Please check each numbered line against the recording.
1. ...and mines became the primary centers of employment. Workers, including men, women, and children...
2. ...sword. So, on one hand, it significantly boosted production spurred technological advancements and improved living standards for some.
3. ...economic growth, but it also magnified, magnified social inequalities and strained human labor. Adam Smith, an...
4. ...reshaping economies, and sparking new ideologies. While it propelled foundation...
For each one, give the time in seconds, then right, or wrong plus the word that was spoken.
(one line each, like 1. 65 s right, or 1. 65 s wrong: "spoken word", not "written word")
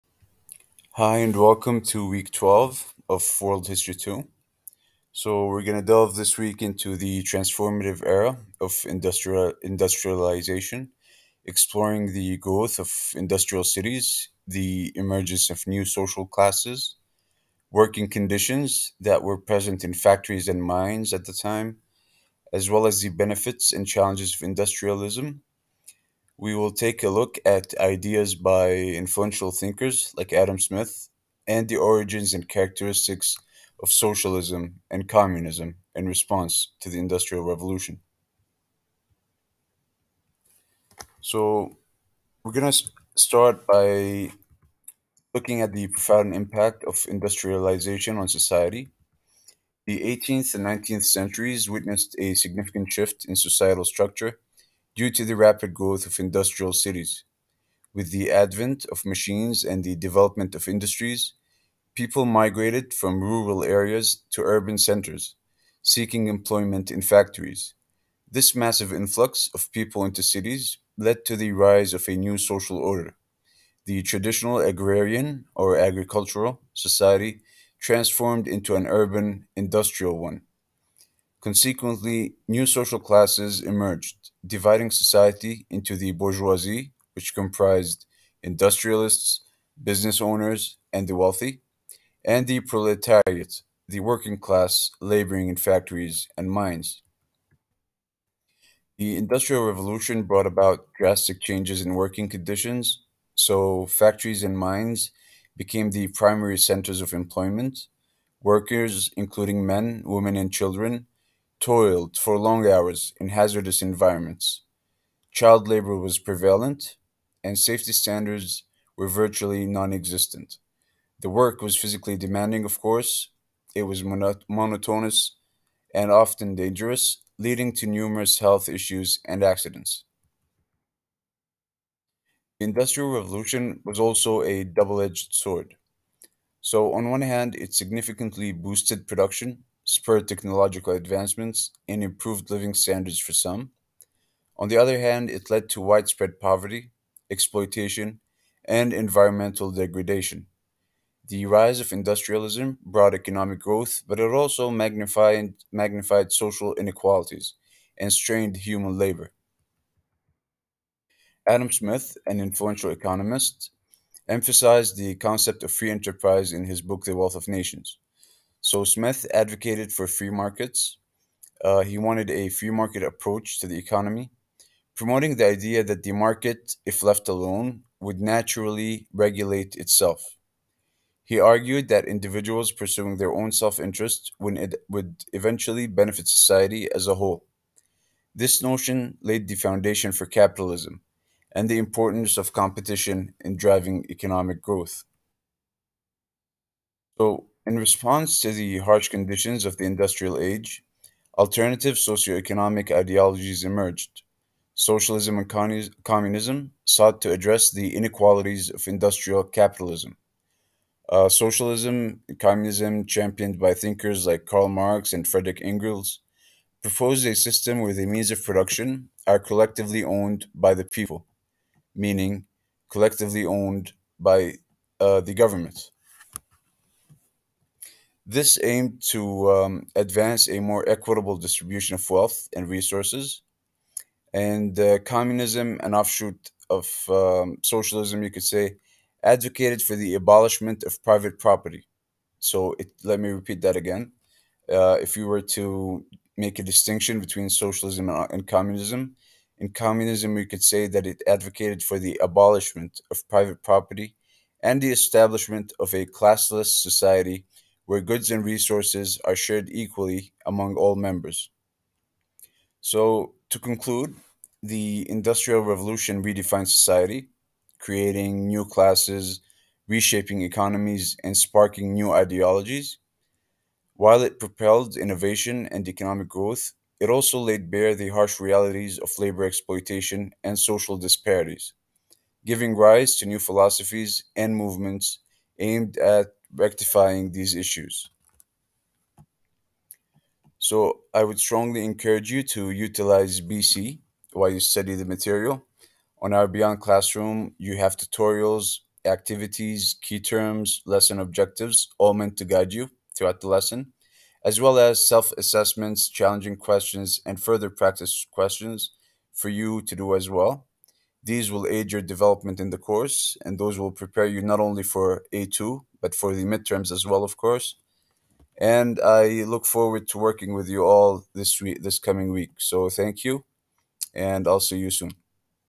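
1. 104 s right
2. 135 s right
3. 153 s right
4. 269 s wrong: "innovation", not "foundation".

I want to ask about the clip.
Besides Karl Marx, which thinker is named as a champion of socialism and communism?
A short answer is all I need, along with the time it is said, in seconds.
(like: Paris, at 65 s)
Frederick Engels, at 215 s.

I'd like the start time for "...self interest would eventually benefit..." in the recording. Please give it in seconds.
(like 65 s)
183 s.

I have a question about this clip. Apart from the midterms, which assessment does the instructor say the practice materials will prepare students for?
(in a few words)
A2.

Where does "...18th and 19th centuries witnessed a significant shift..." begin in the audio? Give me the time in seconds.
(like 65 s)
49 s.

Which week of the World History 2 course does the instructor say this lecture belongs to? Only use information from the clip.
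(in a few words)
Week 12.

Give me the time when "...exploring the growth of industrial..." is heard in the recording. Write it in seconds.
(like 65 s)
11 s.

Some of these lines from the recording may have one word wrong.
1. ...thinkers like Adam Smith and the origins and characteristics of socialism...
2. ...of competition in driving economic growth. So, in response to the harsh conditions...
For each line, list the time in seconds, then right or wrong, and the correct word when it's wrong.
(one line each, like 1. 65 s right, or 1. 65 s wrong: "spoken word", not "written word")
1. 29 s right
2. 192 s right.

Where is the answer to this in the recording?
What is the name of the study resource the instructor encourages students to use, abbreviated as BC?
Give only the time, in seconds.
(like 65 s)
296 s.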